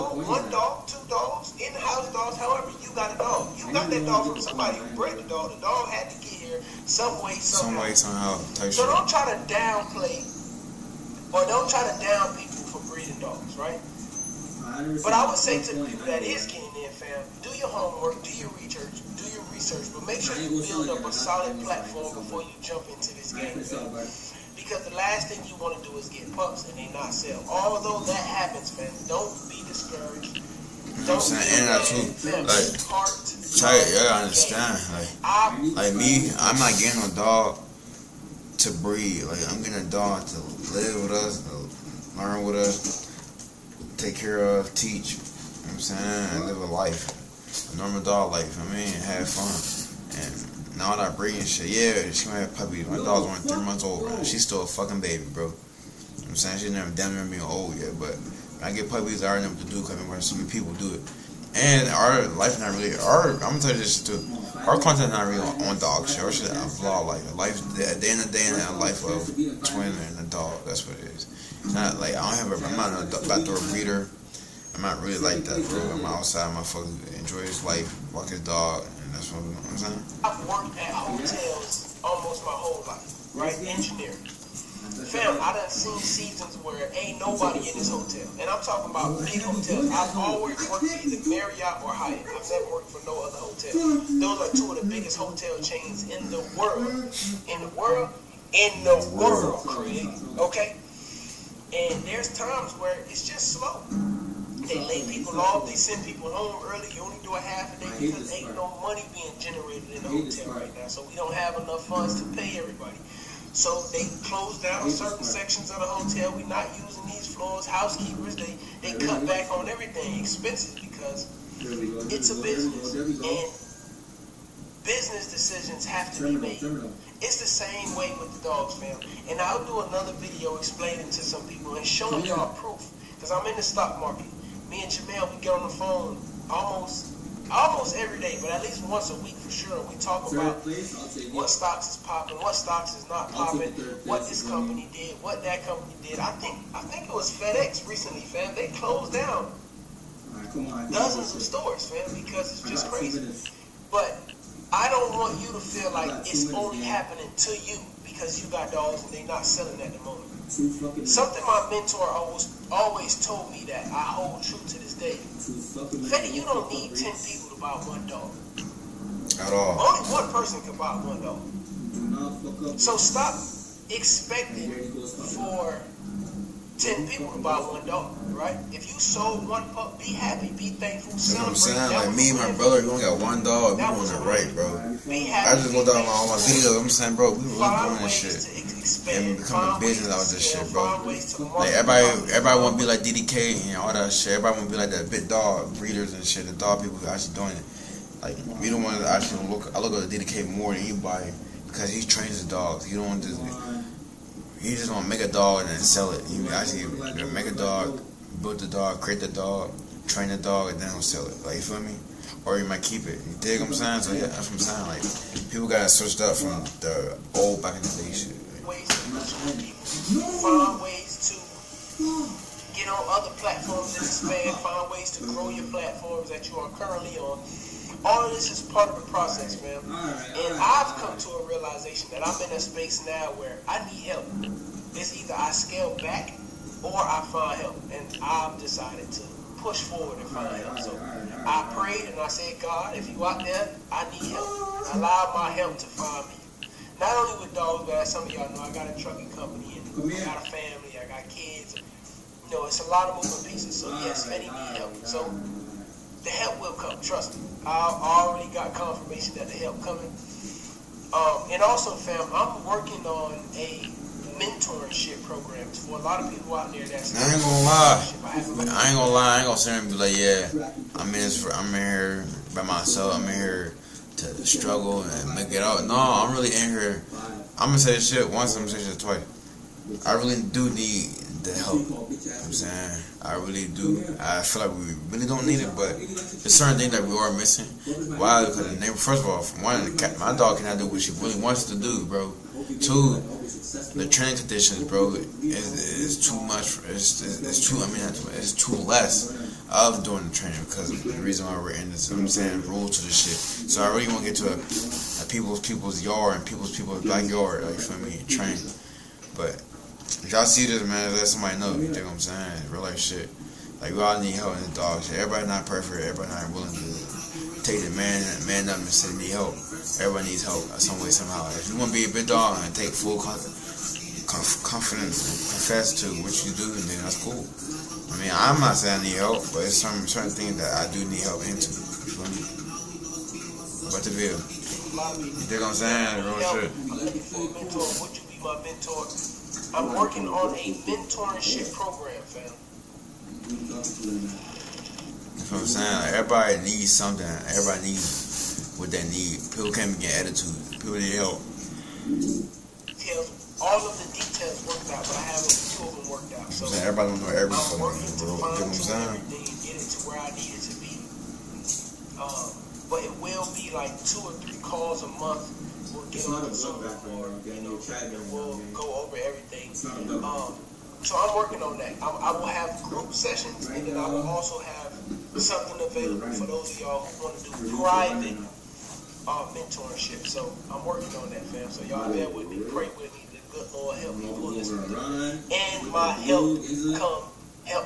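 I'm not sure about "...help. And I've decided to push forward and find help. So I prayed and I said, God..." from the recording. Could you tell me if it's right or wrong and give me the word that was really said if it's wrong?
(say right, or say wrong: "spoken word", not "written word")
right.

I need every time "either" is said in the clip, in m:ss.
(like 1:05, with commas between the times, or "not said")
1:31, 3:55.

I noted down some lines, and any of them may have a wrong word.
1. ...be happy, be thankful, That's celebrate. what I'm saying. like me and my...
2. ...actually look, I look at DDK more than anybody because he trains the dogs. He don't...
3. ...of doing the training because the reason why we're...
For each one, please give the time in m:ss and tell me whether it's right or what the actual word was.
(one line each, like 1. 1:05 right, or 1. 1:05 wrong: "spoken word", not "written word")
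1. 2:59 right
2. 3:19 right
3. 4:59 right.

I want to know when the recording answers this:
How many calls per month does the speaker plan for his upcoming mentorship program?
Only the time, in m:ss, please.
6:04.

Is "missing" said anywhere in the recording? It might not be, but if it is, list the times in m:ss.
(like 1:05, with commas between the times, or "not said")
4:47.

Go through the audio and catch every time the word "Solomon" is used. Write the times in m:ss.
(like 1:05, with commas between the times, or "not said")
not said.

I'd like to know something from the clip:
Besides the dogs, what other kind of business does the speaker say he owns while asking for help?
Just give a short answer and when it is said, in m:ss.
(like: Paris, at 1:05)
Trucking company, at 4:09.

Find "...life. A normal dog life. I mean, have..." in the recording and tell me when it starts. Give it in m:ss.
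0:46.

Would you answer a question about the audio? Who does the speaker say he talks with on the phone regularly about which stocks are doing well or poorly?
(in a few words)
Jamel.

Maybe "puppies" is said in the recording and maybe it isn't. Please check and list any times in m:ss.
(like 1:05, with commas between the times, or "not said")
0:52, 0:58.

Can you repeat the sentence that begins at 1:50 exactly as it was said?
So we don't have enough funds to pay everybody.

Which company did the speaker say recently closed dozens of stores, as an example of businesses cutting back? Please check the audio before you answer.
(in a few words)
FedEx.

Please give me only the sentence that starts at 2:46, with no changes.
Fetty, you don't need ten people to buy one dog.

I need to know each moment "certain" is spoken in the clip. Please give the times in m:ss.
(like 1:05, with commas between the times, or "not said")
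1:54, 4:46, 5:30.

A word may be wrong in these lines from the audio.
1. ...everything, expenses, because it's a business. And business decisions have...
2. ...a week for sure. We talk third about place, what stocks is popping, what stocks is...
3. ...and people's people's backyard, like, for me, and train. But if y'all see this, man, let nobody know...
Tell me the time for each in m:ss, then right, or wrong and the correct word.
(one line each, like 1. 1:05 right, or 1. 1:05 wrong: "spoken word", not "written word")
1. 1:59 right
2. 2:19 right
3. 5:06 wrong: "somebody", not "nobody".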